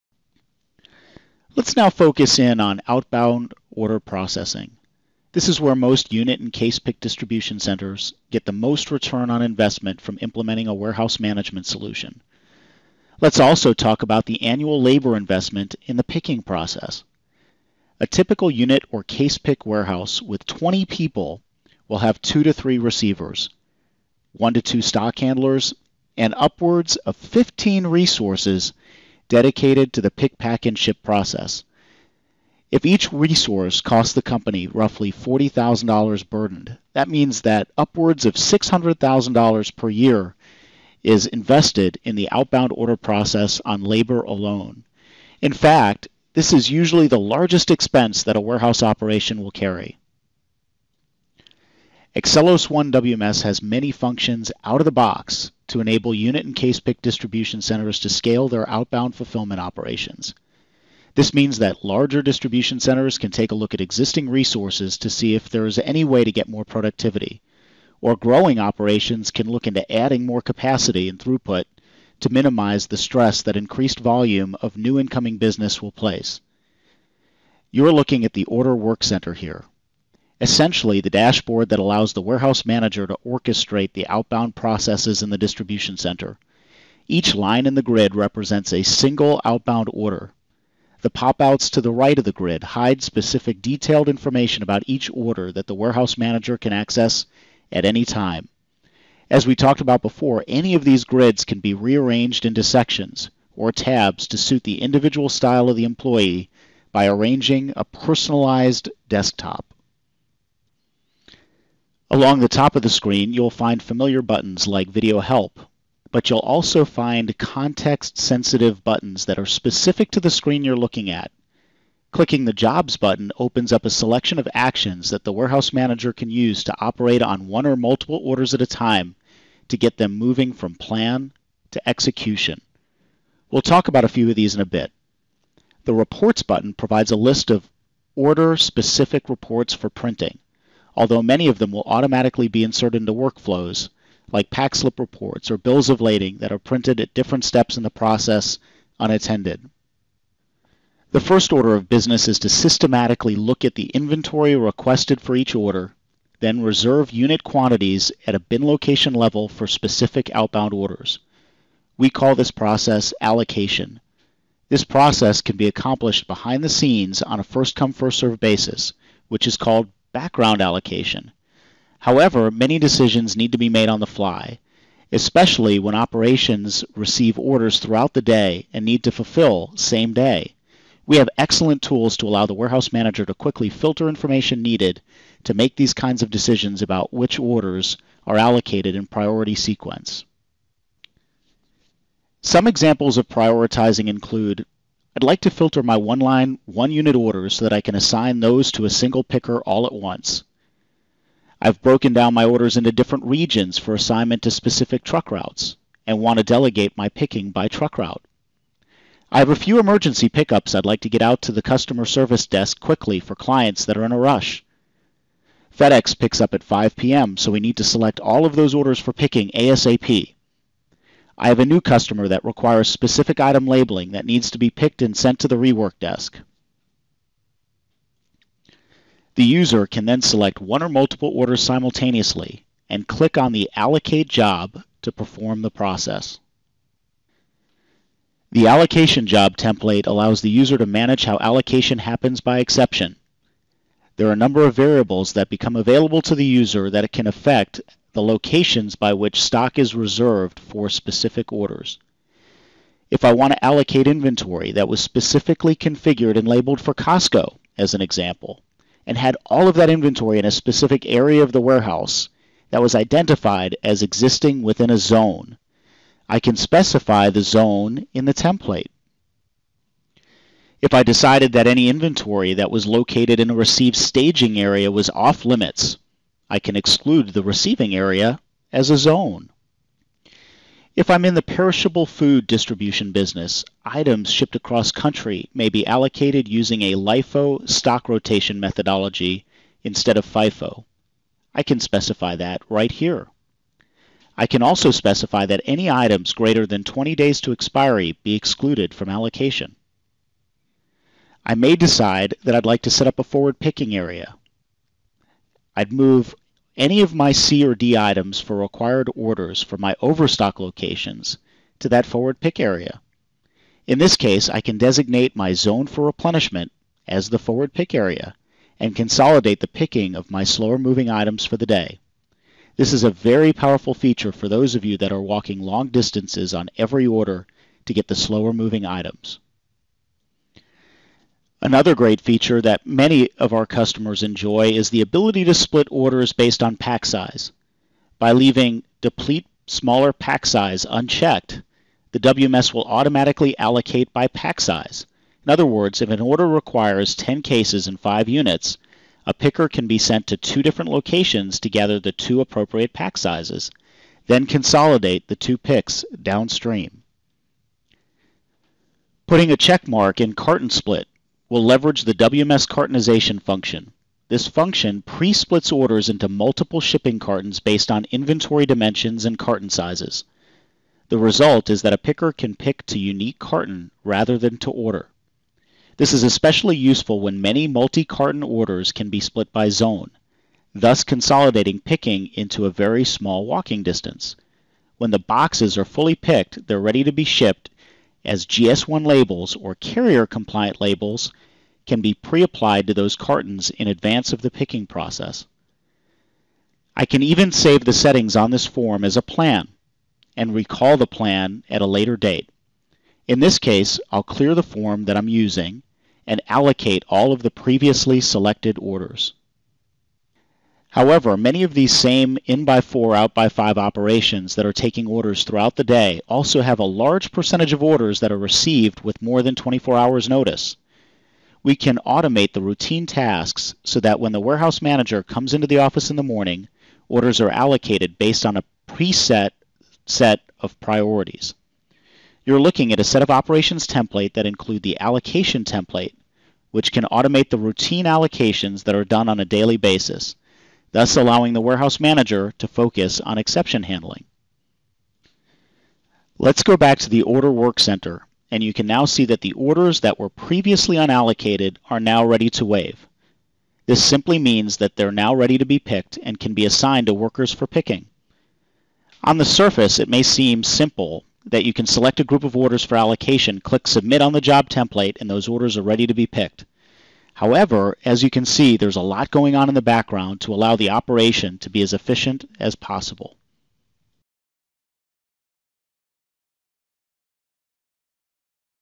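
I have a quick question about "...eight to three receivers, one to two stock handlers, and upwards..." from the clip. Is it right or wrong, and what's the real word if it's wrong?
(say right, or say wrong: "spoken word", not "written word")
wrong: "two", not "eight".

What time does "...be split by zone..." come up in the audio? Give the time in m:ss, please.
6:19.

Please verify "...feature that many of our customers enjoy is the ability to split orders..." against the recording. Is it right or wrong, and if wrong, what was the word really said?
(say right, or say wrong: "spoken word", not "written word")
right.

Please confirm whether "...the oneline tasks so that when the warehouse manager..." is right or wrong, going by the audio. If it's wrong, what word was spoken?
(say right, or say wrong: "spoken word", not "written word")
wrong: "routine", not "oneline".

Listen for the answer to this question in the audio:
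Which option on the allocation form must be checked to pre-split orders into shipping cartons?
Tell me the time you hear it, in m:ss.
6:00.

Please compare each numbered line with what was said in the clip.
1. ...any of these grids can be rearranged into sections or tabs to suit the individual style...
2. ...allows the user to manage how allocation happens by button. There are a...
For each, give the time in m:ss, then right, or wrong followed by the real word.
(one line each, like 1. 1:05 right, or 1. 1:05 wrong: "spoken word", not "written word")
1. 1:40 right
2. 4:00 wrong: "exception", not "button".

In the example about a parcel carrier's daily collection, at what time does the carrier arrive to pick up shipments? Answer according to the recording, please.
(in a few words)
5 p.m.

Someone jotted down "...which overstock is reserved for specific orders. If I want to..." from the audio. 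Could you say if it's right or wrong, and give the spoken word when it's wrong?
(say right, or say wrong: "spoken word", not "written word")
wrong: "stock", not "overstock".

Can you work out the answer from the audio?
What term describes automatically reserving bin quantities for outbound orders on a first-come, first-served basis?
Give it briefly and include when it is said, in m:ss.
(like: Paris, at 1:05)
background allocation, at 2:50.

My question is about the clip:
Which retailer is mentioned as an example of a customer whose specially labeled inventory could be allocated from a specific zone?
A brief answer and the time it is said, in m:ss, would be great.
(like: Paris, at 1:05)
Costco, at 4:16.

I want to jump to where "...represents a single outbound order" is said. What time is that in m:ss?
1:28.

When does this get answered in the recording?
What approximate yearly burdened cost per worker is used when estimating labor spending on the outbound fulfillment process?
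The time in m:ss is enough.
0:35.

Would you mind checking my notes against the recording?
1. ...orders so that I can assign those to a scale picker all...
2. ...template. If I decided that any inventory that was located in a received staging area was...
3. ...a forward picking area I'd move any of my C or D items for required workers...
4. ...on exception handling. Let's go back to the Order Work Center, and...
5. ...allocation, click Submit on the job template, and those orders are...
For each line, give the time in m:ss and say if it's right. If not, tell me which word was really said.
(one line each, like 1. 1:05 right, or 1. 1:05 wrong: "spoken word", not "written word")
1. 3:17 wrong: "single", not "scale"
2. 4:28 right
3. 5:03 wrong: "orders", not "workers"
4. 7:23 right
5. 7:42 right.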